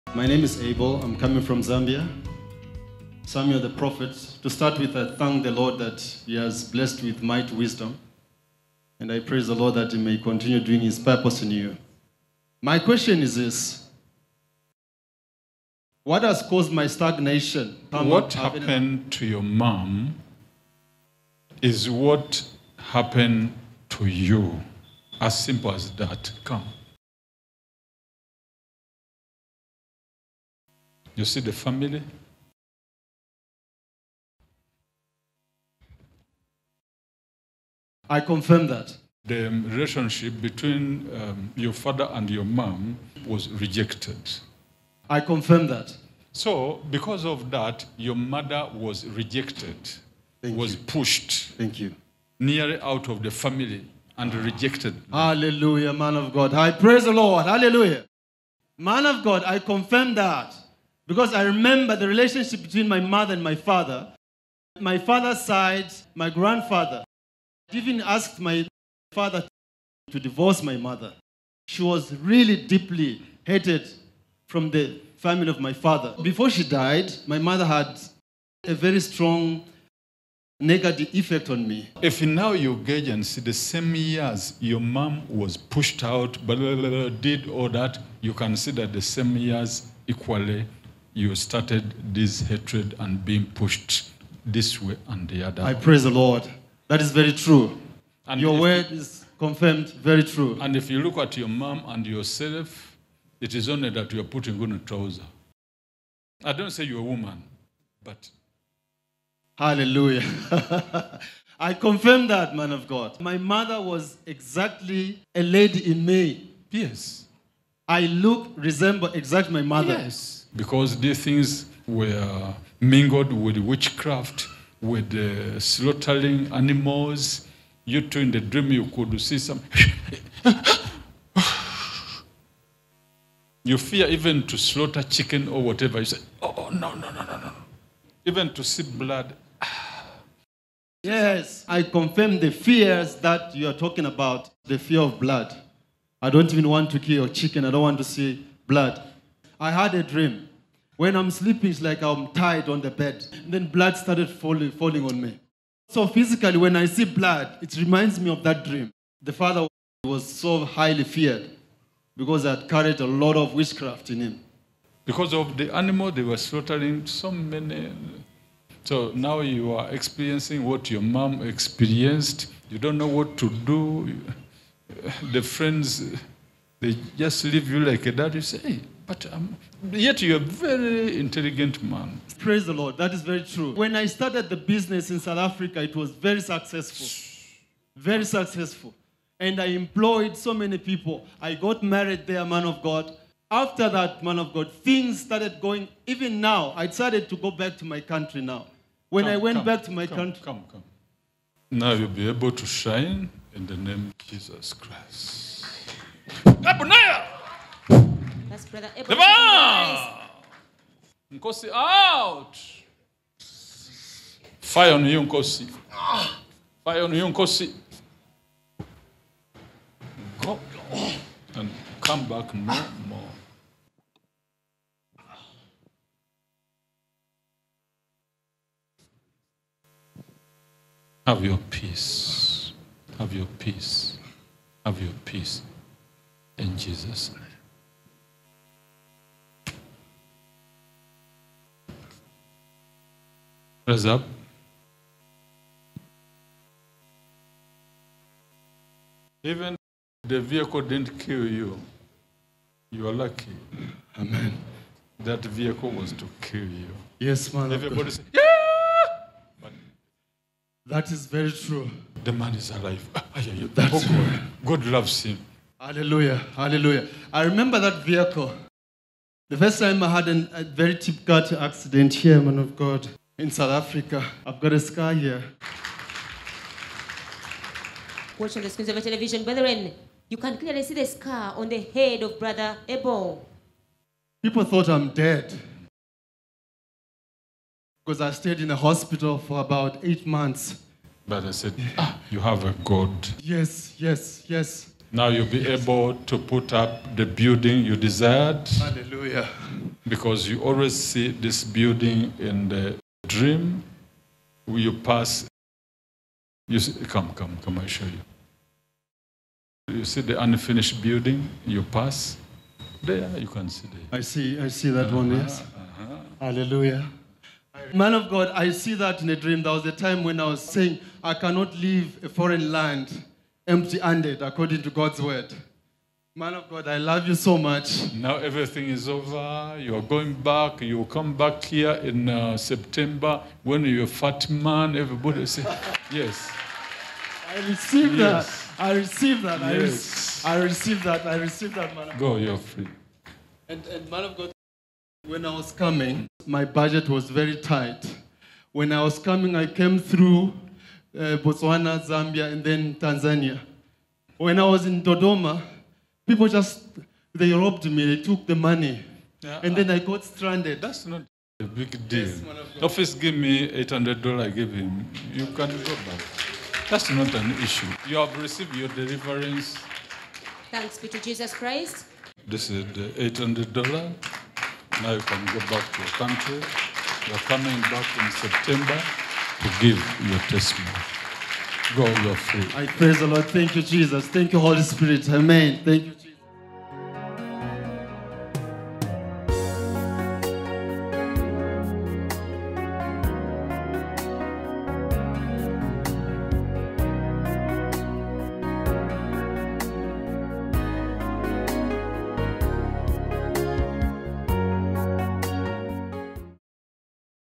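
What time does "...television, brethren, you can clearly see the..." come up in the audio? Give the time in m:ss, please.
4:39.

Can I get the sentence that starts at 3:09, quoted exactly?
And I employed so many people.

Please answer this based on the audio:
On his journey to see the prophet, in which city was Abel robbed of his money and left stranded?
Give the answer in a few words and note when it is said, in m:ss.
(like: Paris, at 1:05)
Dodoma, at 5:55.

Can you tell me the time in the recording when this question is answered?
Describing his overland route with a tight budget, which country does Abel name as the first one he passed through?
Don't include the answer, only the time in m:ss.
5:51.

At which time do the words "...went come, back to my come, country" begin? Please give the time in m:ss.
3:19.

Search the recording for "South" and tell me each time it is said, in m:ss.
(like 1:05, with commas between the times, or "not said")
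3:05, 4:33.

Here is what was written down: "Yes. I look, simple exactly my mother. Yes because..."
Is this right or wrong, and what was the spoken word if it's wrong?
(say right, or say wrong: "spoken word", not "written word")
wrong: "resemble", not "simple".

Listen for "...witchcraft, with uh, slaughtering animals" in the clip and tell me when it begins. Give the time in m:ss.
2:03.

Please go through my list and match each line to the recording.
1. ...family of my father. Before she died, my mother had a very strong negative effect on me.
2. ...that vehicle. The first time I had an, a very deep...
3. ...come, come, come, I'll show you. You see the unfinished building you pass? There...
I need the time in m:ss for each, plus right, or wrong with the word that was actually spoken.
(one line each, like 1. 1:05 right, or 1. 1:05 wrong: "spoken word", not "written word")
1. 1:15 right
2. 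4:27 right
3. 5:07 right.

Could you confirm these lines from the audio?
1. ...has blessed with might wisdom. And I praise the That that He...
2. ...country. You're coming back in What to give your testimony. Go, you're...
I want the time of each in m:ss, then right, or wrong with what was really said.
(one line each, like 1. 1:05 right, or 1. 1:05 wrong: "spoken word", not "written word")
1. 0:06 wrong: "Lord", not "That"
2. 6:16 wrong: "September", not "What".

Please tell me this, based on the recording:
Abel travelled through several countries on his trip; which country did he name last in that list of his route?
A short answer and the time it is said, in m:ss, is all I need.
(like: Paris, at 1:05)
Tanzania, at 5:52.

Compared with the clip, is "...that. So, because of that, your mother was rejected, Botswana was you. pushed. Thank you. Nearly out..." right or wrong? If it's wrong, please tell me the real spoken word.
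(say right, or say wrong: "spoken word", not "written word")
wrong: "Thank", not "Botswana".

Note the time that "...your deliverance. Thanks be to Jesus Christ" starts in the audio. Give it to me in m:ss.
6:08.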